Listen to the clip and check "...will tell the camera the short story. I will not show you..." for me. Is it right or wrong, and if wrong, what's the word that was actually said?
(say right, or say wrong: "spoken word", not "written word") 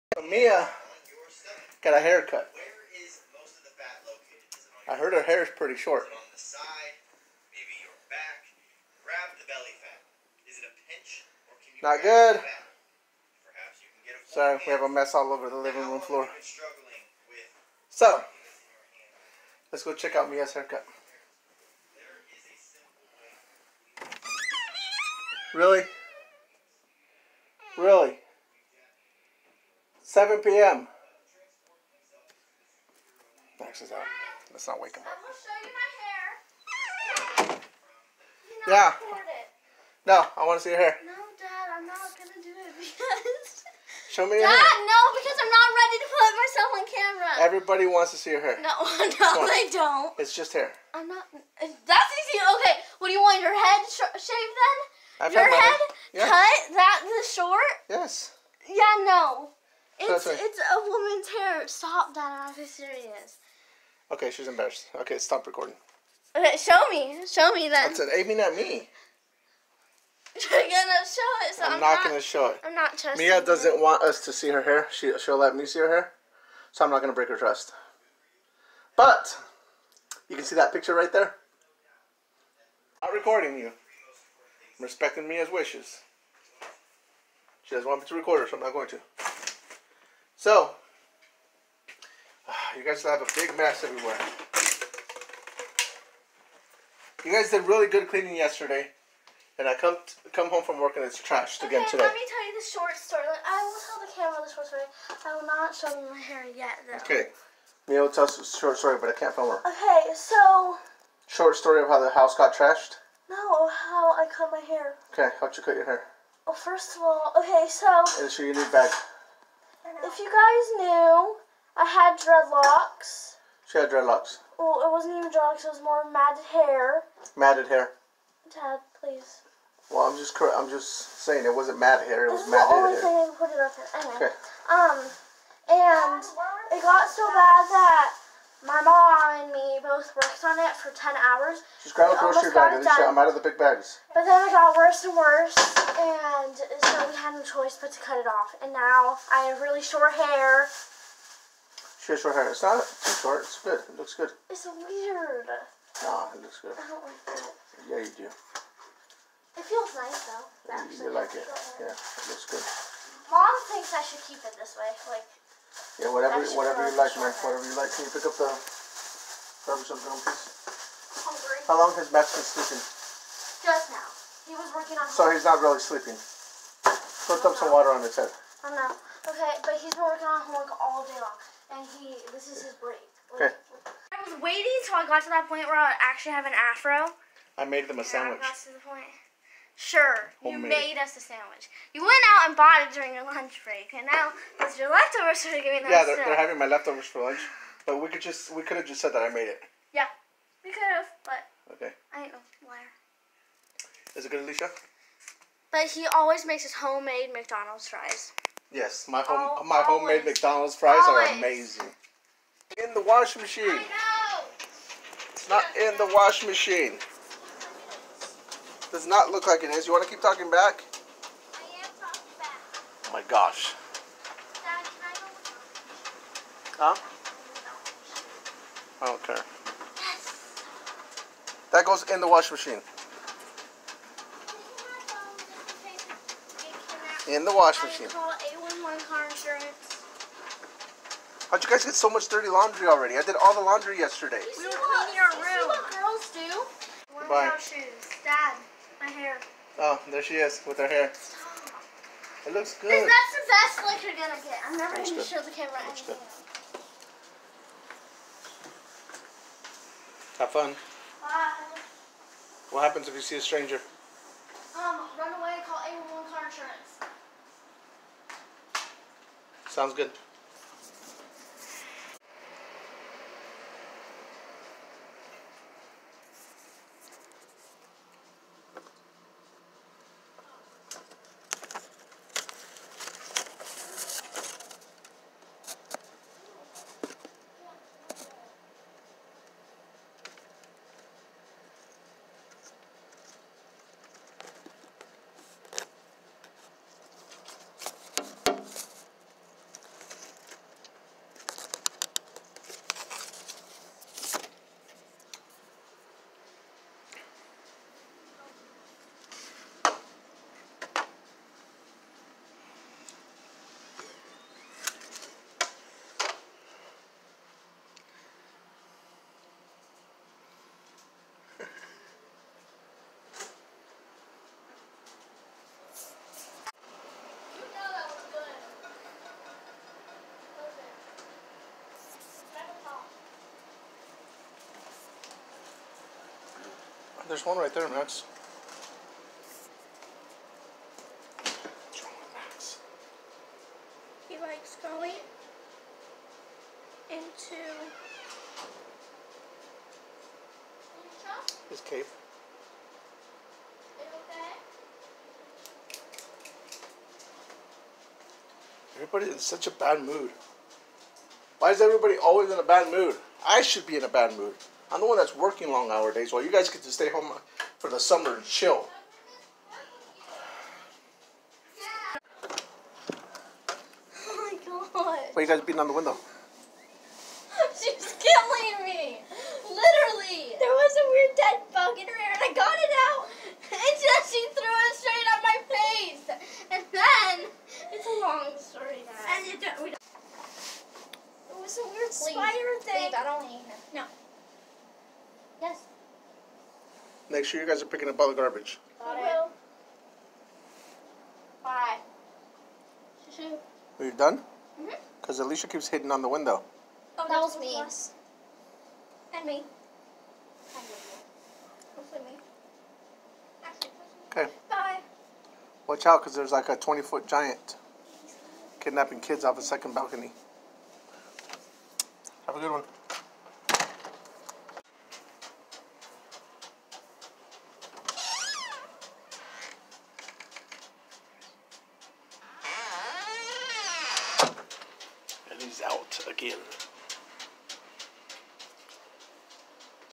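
right.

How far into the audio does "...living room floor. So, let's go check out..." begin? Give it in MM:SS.
00:15.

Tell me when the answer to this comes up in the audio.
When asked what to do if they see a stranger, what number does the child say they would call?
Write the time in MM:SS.
04:25.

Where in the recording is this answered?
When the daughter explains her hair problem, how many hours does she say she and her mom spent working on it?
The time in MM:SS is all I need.
02:20.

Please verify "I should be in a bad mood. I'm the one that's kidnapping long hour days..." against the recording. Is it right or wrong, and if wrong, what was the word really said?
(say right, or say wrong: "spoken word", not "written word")
wrong: "working", not "kidnapping".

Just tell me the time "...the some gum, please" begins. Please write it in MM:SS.
02:48.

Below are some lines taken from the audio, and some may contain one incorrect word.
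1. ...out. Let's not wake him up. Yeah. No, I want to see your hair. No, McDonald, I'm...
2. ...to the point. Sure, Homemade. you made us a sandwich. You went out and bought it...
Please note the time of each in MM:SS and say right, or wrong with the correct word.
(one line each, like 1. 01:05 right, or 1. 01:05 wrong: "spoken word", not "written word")
1. 00:33 wrong: "Dad", not "McDonald"
2. 03:08 right.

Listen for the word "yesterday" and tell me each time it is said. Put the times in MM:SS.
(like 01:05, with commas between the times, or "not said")
01:38, 04:03.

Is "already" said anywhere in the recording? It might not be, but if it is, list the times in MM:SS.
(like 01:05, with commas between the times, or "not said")
04:02.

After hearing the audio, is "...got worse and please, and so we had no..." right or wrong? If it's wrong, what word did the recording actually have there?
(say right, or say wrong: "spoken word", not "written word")
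wrong: "worse", not "please".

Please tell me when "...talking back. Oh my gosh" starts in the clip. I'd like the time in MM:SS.
03:42.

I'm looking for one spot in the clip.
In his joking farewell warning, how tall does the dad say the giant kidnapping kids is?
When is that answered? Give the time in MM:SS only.
06:56.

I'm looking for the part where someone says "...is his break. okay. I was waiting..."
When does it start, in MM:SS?
03:02.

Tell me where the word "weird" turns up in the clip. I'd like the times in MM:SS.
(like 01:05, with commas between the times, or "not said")
02:34, 06:21.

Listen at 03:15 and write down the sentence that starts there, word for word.
Yeah, they're, they're having my leftovers for lunch, but we could just we could have just said that I made it.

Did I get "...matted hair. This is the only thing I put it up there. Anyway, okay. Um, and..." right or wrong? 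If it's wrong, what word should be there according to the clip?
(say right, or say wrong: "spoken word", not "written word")
right.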